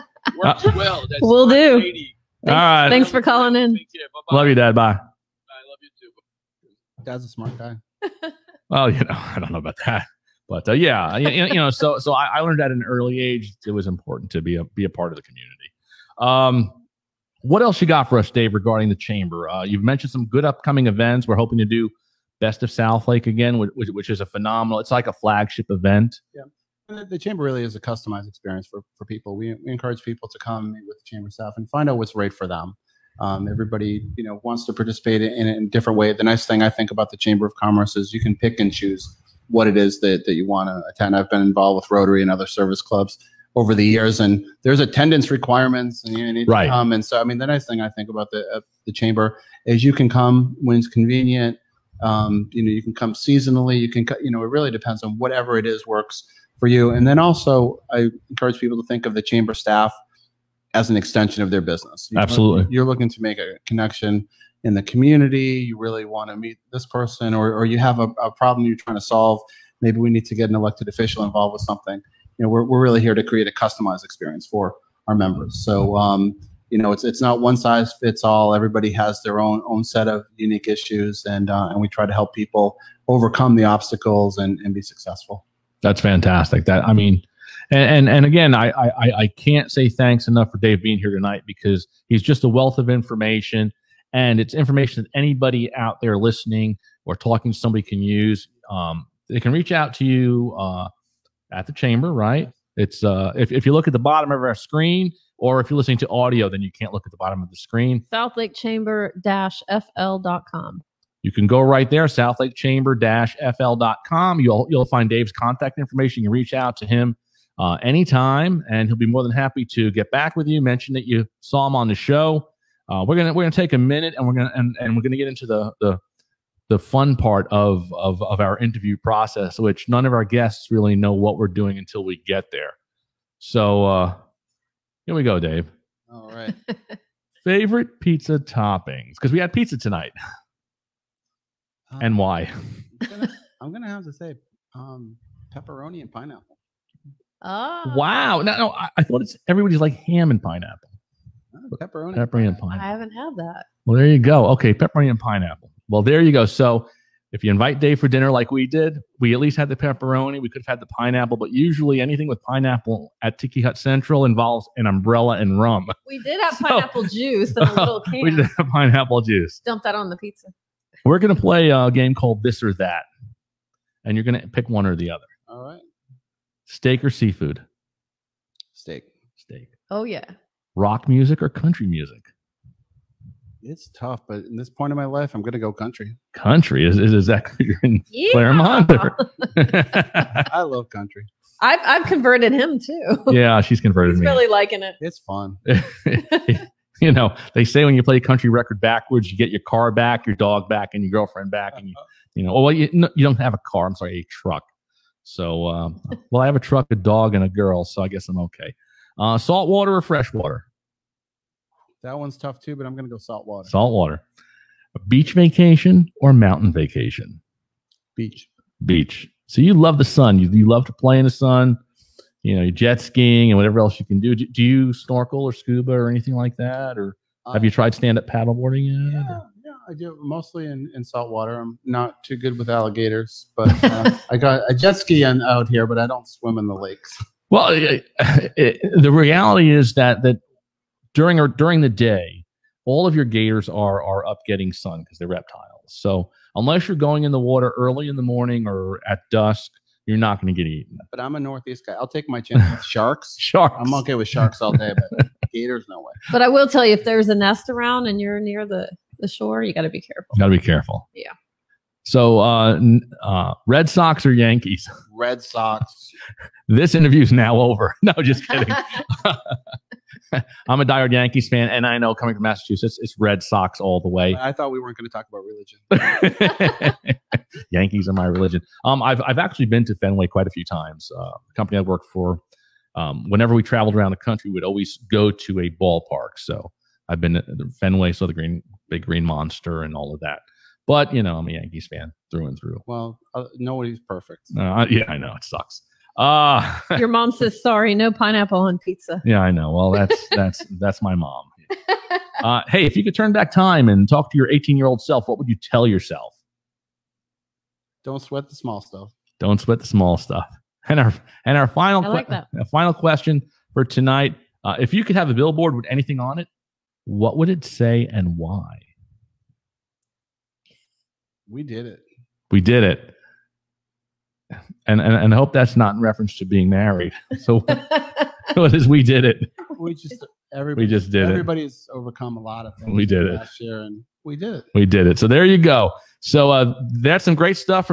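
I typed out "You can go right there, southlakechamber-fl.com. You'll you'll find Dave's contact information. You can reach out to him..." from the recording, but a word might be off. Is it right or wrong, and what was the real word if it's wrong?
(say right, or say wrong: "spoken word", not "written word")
right.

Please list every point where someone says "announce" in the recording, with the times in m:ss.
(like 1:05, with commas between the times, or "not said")
not said.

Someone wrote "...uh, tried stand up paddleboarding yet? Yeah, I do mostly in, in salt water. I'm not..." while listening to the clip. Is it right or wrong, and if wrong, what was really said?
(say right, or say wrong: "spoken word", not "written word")
right.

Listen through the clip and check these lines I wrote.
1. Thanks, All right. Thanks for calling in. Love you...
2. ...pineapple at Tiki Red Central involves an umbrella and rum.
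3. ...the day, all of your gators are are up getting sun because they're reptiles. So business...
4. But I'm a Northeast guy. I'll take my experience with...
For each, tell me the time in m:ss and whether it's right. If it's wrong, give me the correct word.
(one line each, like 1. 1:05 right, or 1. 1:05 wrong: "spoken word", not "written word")
1. 0:01 right
2. 2:42 wrong: "Hut", not "Red"
3. 4:01 wrong: "unless", not "business"
4. 4:11 wrong: "chance", not "experience".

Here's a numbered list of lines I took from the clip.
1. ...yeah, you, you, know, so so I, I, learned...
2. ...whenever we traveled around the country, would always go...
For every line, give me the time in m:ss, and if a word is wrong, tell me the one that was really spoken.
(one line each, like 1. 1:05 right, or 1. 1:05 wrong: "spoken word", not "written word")
1. 0:10 right
2. 4:43 right.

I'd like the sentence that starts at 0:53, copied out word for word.
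You can, you know, it really depends on whatever it is works for you.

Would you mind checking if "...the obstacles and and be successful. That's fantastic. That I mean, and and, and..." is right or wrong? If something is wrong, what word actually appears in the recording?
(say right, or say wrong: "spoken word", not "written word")
right.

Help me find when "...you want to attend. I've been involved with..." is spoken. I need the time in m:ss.
0:40.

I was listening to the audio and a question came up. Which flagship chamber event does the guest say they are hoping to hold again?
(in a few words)
Best of South Lake.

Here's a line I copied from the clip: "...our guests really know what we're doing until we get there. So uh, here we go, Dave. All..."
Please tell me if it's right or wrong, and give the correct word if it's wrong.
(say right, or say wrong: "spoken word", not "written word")
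right.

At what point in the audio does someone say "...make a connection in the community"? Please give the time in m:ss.
1:03.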